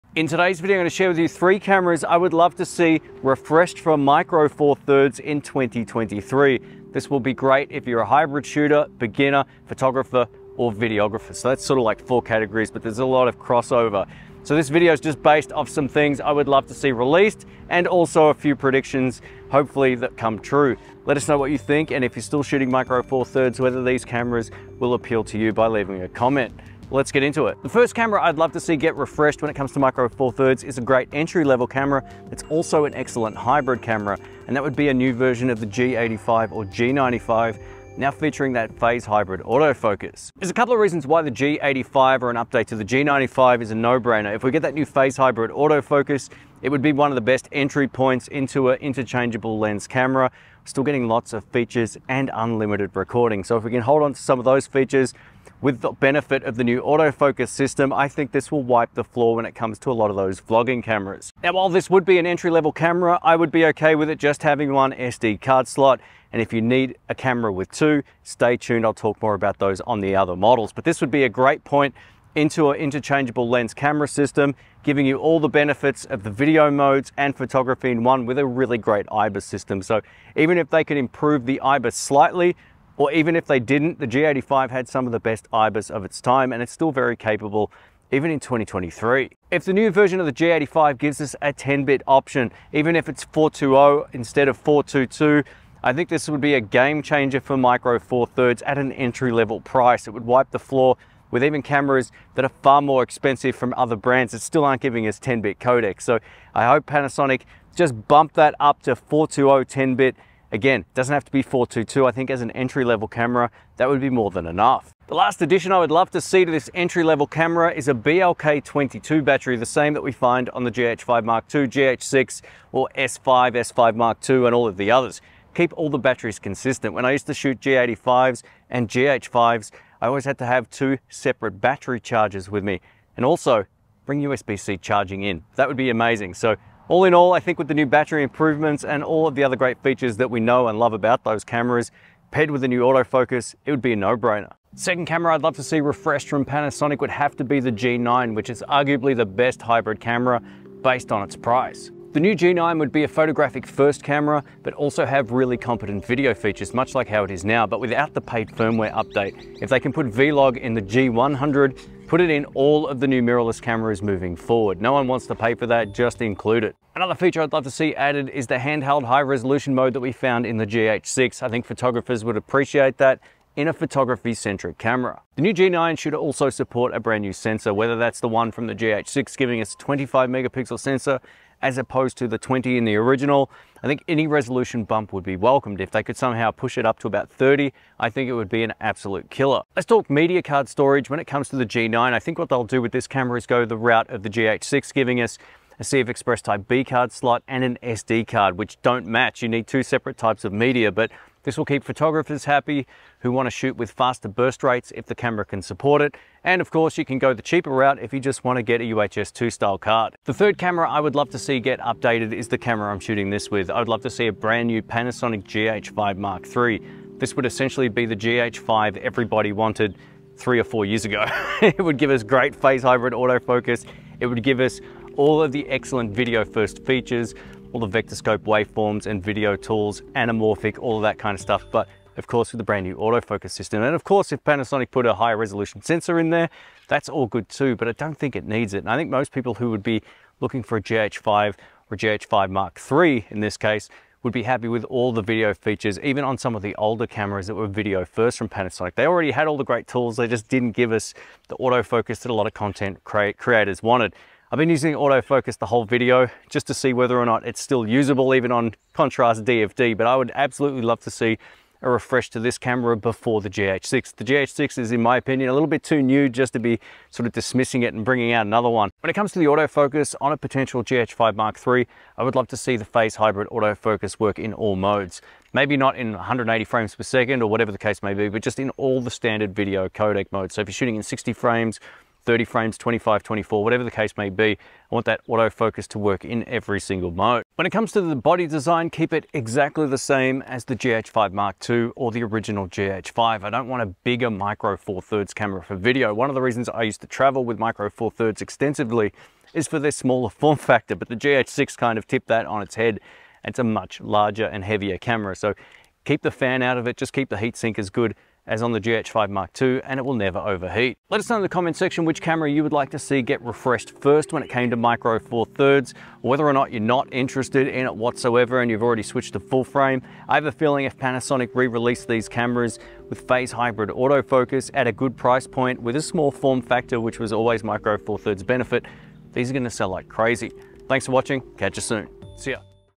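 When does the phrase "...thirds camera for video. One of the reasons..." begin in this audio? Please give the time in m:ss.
4:55.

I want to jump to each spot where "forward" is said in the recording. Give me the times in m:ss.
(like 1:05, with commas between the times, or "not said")
2:44.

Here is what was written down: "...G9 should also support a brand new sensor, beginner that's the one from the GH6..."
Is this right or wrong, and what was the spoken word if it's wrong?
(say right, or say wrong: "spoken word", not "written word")
wrong: "whether", not "beginner".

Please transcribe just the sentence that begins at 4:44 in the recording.
I want that autofocus to work in every single mode.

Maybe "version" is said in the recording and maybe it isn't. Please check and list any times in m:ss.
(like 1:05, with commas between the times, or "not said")
0:35, 1:29.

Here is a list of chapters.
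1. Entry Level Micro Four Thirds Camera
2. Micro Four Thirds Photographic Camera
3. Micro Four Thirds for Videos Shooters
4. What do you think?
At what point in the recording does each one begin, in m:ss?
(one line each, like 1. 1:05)
1. 0:27
2. 2:24
3. 3:30
4. 5:11.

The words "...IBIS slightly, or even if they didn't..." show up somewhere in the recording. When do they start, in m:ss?
1:21.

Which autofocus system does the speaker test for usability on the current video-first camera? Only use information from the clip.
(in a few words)
Contrast DFD.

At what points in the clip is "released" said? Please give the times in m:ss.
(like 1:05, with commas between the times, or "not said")
0:16, 5:21.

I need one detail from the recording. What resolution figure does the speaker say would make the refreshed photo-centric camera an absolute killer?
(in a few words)
30.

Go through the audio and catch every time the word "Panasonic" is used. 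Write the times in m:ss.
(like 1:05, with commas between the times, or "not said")
1:46, 2:26, 3:34, 3:54, 4:08, 5:20.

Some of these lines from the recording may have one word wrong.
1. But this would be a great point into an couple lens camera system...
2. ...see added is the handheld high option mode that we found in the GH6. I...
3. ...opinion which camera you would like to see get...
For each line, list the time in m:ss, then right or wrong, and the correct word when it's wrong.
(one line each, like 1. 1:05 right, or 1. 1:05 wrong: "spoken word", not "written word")
1. 1:10 wrong: "interchangeable", not "couple"
2. 2:47 wrong: "resolution", not "option"
3. 5:11 wrong: "section", not "opinion".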